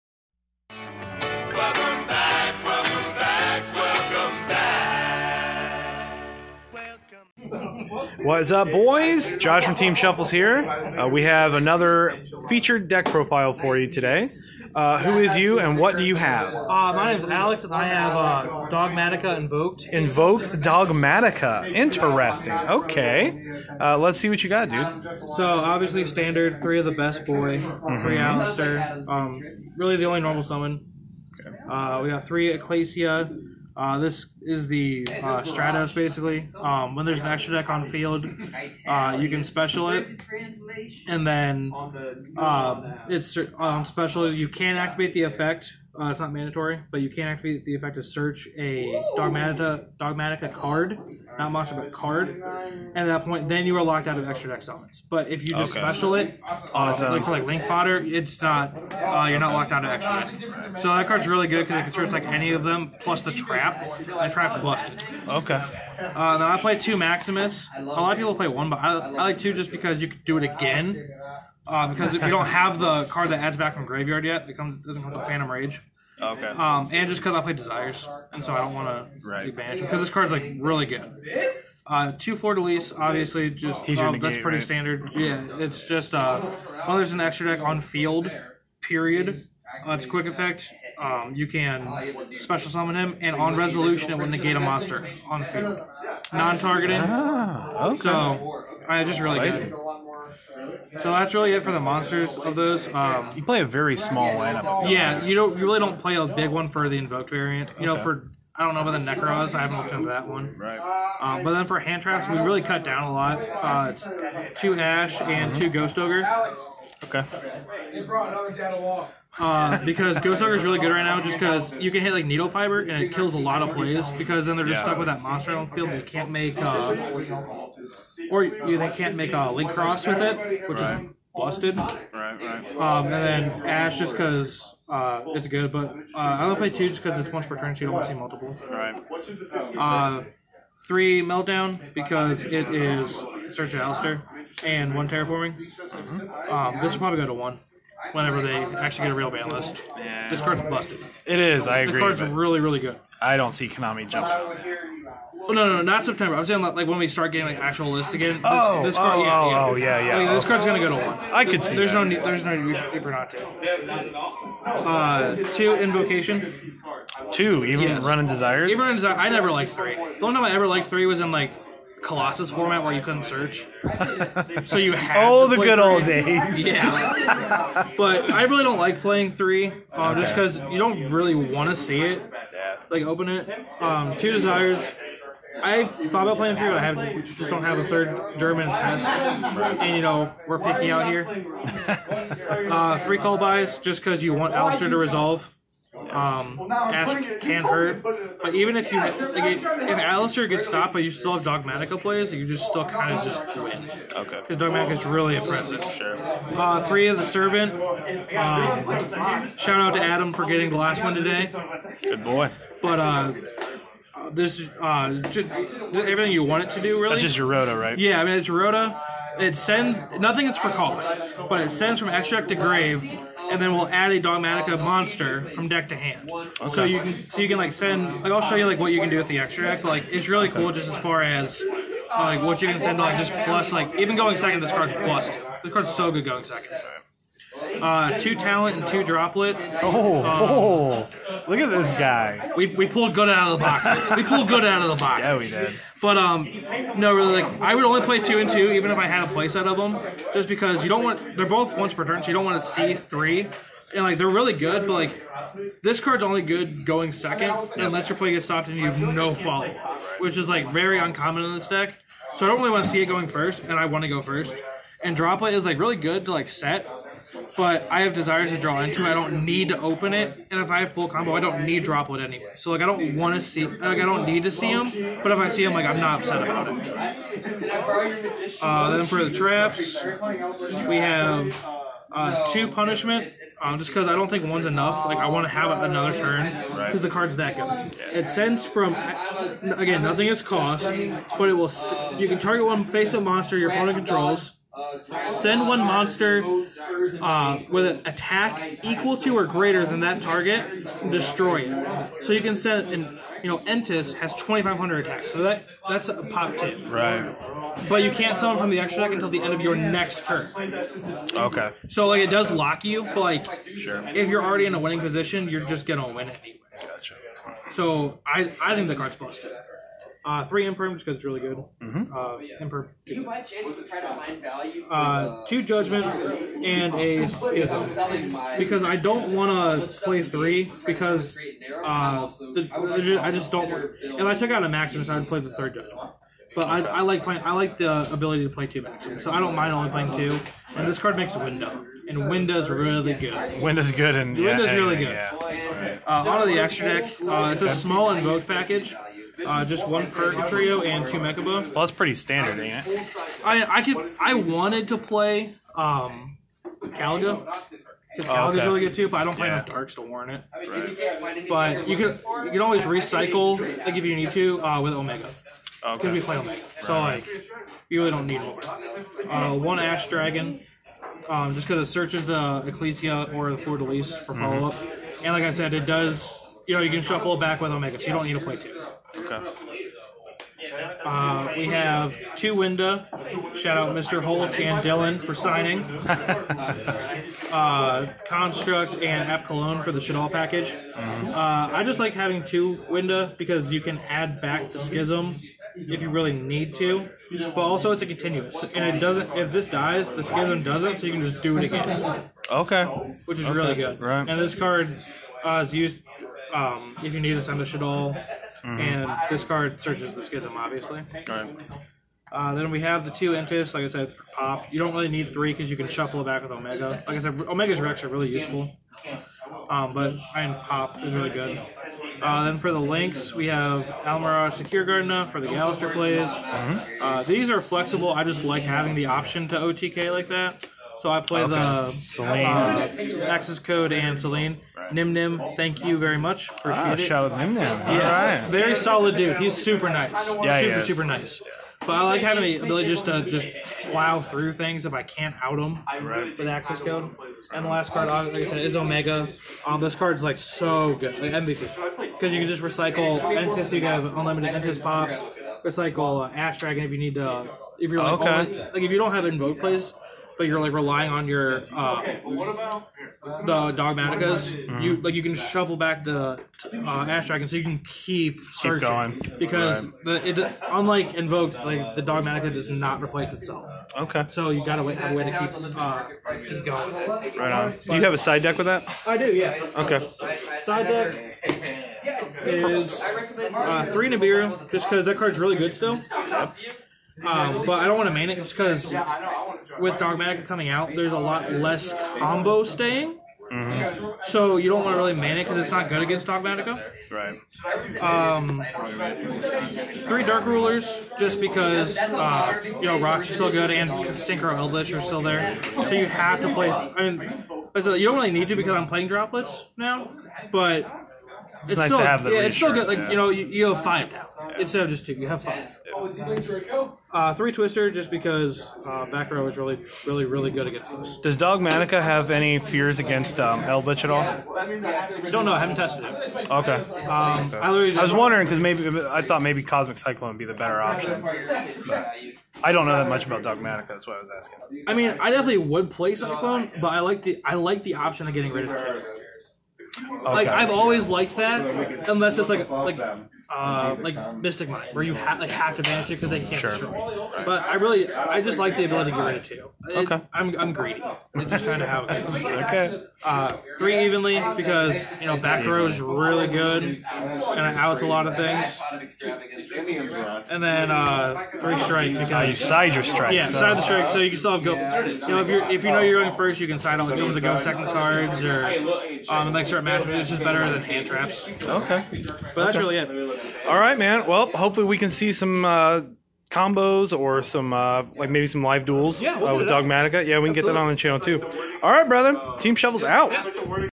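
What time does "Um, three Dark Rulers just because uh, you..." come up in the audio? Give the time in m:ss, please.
8:18.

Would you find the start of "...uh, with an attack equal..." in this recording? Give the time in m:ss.
4:57.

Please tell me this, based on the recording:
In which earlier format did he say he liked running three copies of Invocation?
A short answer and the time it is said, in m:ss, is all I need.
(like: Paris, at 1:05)
Colossus format, at 2:52.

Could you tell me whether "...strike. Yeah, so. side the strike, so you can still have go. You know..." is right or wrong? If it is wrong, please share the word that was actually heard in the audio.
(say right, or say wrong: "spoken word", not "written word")
right.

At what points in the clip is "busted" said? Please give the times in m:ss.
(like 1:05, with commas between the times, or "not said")
1:04, 2:11, 2:30, 5:19.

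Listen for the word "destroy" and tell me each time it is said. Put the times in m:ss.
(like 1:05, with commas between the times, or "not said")
5:01, 9:06.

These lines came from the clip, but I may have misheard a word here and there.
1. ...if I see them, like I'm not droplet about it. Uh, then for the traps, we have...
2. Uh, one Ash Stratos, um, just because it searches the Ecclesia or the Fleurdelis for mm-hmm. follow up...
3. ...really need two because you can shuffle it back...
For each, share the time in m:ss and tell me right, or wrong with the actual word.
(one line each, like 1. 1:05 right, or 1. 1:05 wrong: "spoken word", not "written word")
1. 4:35 wrong: "upset", not "droplet"
2. 6:09 wrong: "Dragon", not "Stratos"
3. 6:54 wrong: "three", not "two".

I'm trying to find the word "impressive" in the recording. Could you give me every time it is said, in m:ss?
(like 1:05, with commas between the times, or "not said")
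3:25.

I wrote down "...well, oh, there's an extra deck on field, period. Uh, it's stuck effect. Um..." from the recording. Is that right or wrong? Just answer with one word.
wrong.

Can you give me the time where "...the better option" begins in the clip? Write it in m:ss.
8:50.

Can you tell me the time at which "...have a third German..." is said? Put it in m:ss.
3:07.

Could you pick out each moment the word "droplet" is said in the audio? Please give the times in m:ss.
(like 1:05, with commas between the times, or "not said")
3:59, 4:25, 4:31, 8:29.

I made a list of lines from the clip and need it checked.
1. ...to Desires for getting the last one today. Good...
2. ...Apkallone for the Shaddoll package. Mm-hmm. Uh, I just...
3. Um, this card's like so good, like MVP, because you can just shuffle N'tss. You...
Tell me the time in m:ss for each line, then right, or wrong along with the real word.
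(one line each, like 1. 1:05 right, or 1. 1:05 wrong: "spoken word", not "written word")
1. 3:29 wrong: "Adam", not "Desires"
2. 6:29 right
3. 7:29 wrong: "recycle", not "shuffle".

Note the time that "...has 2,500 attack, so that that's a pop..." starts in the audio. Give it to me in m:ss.
5:04.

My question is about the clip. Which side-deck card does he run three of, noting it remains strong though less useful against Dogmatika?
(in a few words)
Nibiru.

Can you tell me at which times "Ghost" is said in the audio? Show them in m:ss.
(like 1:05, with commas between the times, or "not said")
1:55, 2:00.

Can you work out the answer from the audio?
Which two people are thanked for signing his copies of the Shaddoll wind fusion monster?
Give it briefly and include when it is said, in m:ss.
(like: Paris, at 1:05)
Mr. Holt and Dylan, at 6:23.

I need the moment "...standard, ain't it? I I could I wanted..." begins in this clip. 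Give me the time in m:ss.
5:52.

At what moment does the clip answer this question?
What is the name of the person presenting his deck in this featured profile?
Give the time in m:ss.
0:17.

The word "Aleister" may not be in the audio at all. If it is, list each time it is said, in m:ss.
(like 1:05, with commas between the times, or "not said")
0:28, 2:23, 3:14, 3:19.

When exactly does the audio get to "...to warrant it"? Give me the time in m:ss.
5:59.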